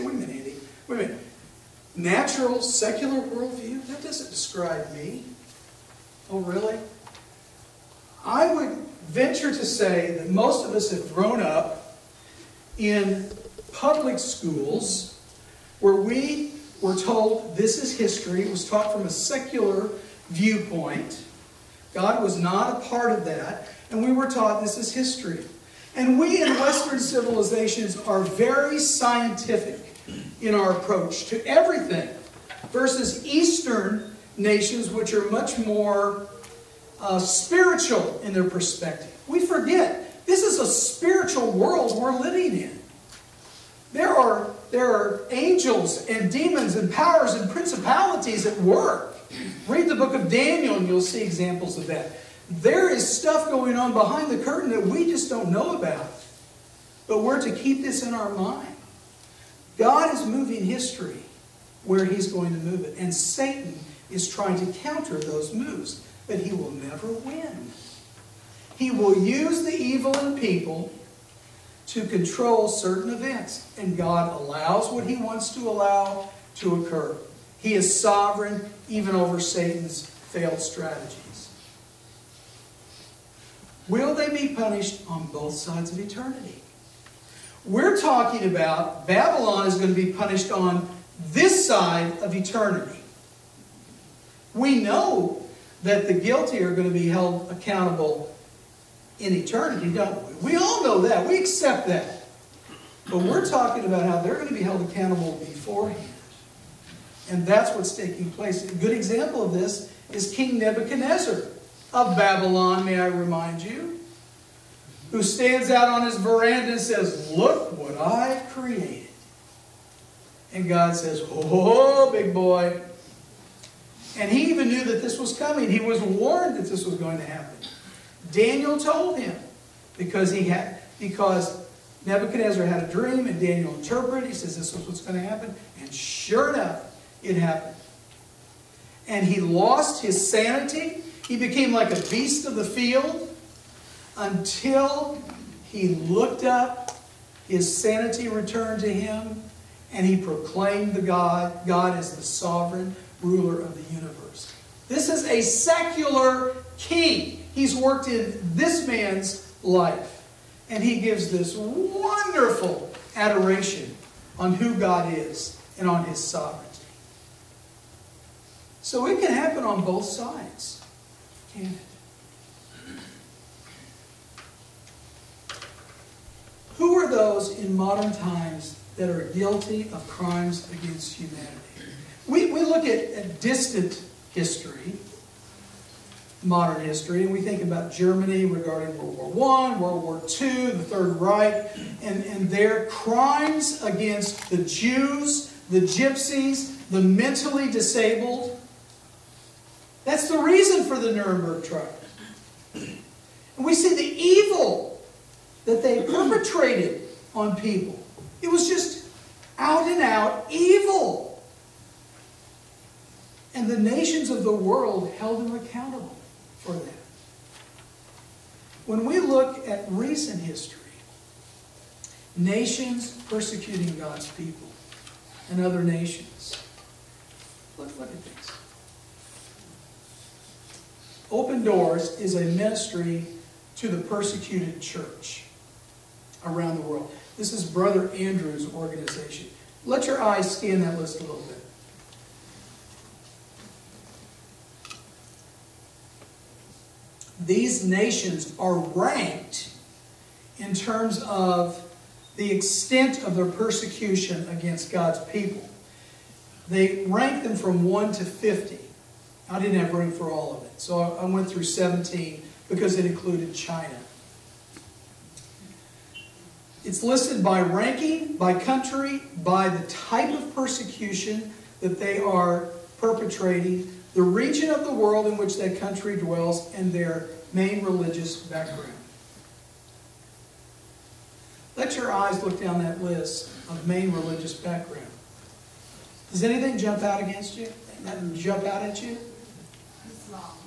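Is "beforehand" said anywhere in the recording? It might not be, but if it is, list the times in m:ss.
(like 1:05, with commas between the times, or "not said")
1:45.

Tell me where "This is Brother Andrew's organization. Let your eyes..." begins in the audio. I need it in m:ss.
3:57.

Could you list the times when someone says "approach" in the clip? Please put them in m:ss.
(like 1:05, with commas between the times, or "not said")
0:30.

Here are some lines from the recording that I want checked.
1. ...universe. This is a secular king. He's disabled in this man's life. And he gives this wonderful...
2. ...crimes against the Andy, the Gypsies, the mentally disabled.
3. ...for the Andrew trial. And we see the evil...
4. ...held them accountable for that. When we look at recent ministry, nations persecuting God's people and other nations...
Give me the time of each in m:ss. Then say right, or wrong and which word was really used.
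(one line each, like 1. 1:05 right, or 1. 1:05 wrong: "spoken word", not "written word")
1. 2:33 wrong: "worked", not "disabled"
2. 3:12 wrong: "Jews", not "Andy"
3. 3:20 wrong: "Nuremberg", not "Andrew"
4. 3:35 wrong: "history", not "ministry".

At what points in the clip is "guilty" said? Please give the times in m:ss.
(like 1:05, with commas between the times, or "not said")
1:36, 2:59.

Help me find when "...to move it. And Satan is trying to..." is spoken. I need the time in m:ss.
1:02.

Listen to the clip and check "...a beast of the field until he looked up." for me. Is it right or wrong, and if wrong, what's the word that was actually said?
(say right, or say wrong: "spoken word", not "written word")
right.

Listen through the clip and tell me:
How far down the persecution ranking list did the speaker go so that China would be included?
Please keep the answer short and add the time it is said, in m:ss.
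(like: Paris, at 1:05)
17, at 4:21.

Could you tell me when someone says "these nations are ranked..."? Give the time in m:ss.
4:07.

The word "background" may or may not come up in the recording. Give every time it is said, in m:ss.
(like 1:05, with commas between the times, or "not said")
4:38, 4:44.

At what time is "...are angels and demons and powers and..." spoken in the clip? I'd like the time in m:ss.
0:44.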